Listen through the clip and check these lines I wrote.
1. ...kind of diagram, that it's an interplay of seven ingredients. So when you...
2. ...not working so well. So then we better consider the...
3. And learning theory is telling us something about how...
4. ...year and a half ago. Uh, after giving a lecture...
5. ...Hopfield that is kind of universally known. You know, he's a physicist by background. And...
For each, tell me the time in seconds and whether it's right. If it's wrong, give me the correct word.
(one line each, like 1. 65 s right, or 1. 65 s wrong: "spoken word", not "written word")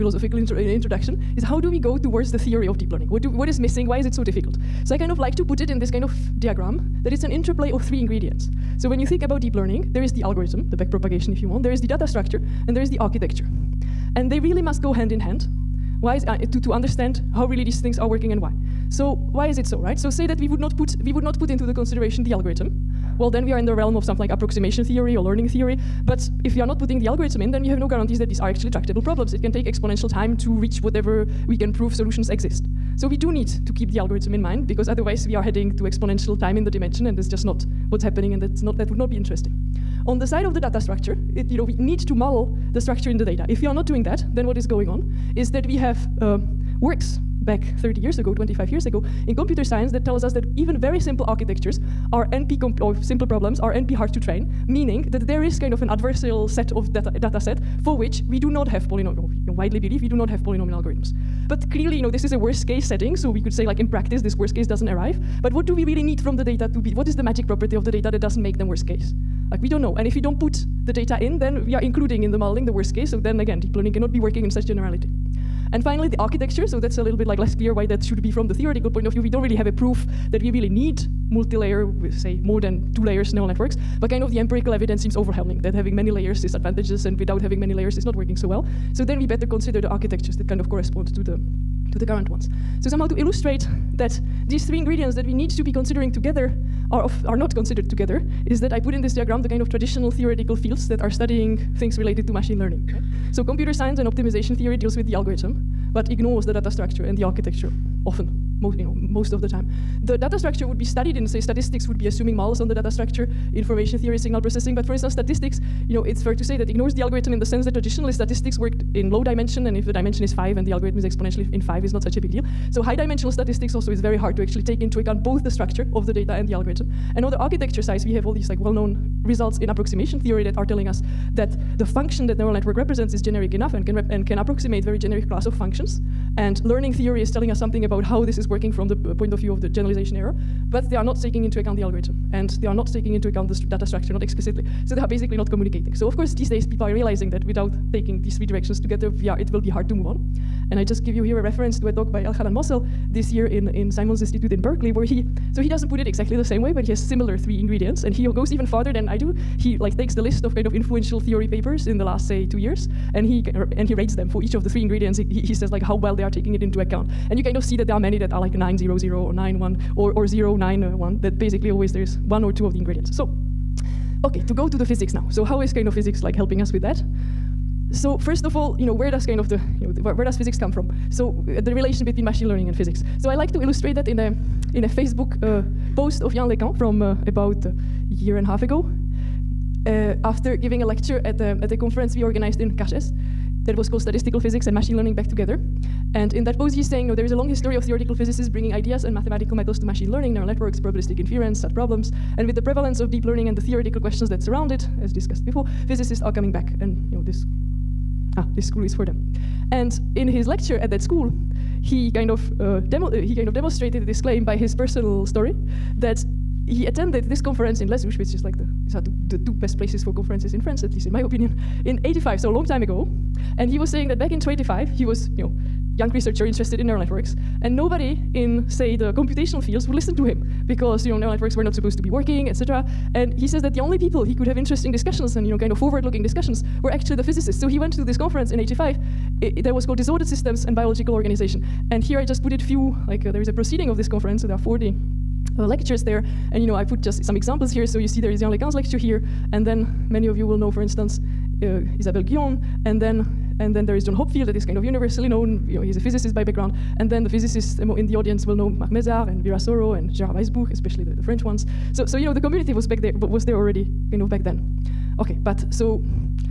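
1. 5 s wrong: "three", not "seven"
2. 88 s right
3. 136 s right
4. 188 s right
5. 254 s right.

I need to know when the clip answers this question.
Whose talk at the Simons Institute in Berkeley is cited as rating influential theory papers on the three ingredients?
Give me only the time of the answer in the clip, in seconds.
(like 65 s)
152 s.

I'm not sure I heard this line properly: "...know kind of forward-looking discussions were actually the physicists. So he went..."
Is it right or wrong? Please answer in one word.
right.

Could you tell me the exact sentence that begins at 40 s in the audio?
On the side of the data structure, it, you know, we need to model the structure in the data.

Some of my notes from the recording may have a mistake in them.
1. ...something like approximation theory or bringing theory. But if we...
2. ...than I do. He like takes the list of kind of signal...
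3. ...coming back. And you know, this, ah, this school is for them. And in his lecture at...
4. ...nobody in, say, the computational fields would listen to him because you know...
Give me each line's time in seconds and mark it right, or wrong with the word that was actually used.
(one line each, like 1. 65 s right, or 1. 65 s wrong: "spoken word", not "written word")
1. 24 s wrong: "learning", not "bringing"
2. 158 s wrong: "influential", not "signal"
3. 206 s right
4. 227 s right.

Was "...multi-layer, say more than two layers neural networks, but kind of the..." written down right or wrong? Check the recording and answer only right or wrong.
right.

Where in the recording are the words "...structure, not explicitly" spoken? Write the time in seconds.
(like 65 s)
143 s.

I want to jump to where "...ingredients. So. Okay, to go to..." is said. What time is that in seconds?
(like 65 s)
172 s.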